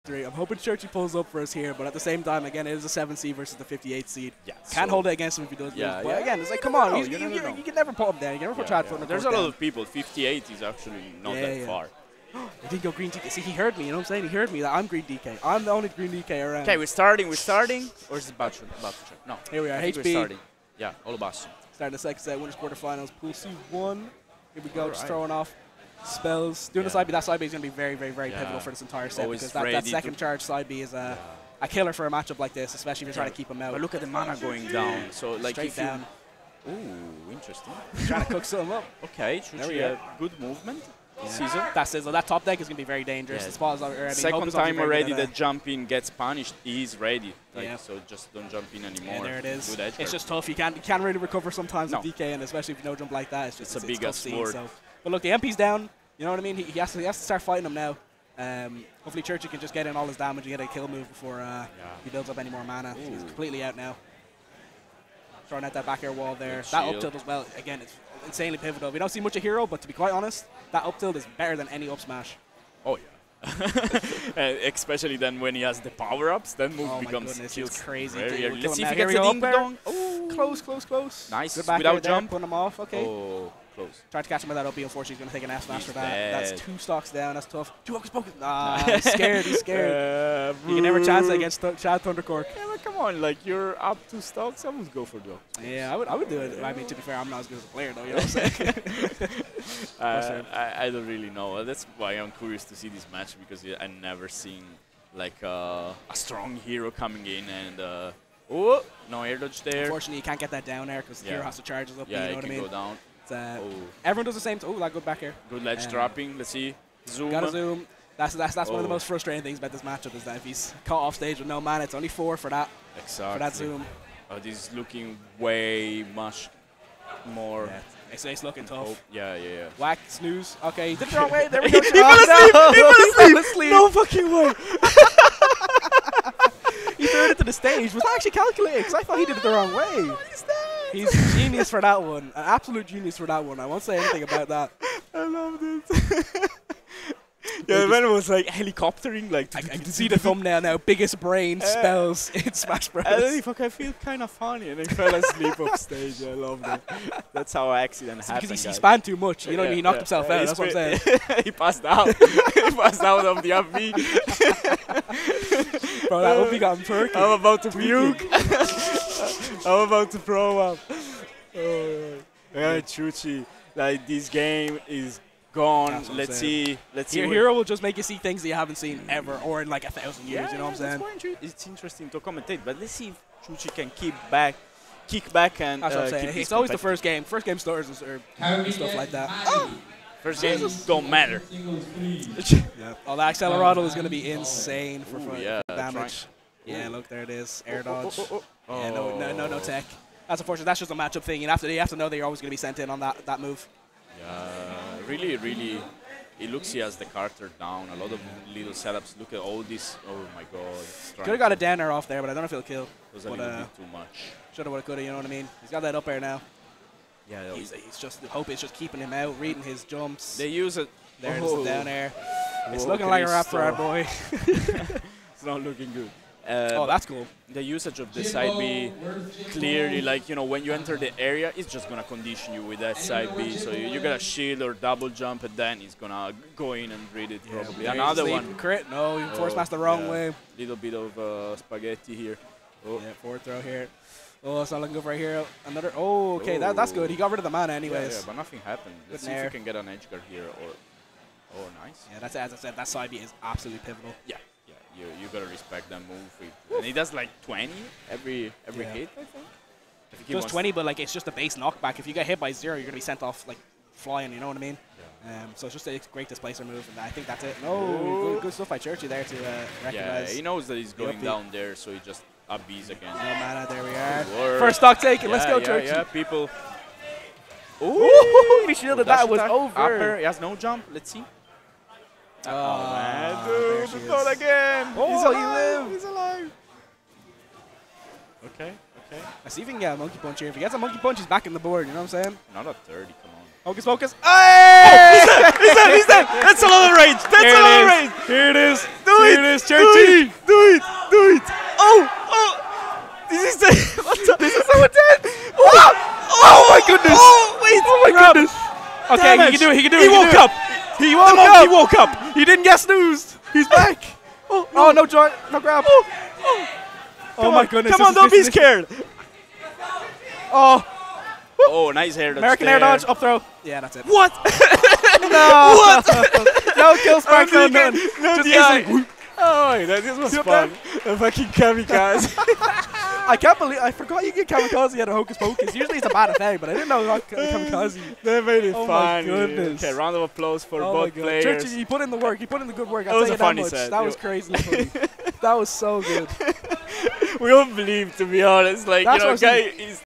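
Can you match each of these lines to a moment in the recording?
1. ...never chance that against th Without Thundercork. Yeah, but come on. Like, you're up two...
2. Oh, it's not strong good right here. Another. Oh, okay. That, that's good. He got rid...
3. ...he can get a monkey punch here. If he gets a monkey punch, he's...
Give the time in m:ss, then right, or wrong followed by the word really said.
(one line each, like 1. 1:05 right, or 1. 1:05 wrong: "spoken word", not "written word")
1. 1:30 wrong: "Chad", not "Without"
2. 4:04 wrong: "looking", not "strong"
3. 4:49 right.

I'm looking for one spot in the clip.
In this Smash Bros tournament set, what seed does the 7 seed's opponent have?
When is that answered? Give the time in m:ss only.
0:03.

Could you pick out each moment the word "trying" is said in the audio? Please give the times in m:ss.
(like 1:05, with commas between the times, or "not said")
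0:33, 0:38, 3:15.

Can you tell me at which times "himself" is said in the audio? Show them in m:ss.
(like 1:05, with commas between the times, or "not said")
2:40.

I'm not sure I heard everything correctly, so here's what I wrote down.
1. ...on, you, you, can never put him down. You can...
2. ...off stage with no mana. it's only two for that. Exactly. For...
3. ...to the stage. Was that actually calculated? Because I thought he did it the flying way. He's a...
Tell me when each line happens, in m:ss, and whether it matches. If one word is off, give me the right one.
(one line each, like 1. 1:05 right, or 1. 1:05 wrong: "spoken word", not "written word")
1. 0:06 right
2. 2:01 wrong: "four", not "two"
3. 2:17 wrong: "wrong", not "flying".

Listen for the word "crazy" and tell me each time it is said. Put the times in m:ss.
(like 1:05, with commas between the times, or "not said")
1:17, 5:44.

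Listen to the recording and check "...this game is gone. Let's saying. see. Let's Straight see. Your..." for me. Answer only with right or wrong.
wrong.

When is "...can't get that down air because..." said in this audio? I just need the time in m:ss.
1:50.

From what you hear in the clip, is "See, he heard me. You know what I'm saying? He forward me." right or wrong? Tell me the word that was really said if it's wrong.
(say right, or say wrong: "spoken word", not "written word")
wrong: "heard", not "forward".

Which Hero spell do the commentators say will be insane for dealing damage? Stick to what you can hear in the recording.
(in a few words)
Accelerado.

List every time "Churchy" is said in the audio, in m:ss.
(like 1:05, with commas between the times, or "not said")
0:00, 0:59, 4:28, 4:35, 5:41.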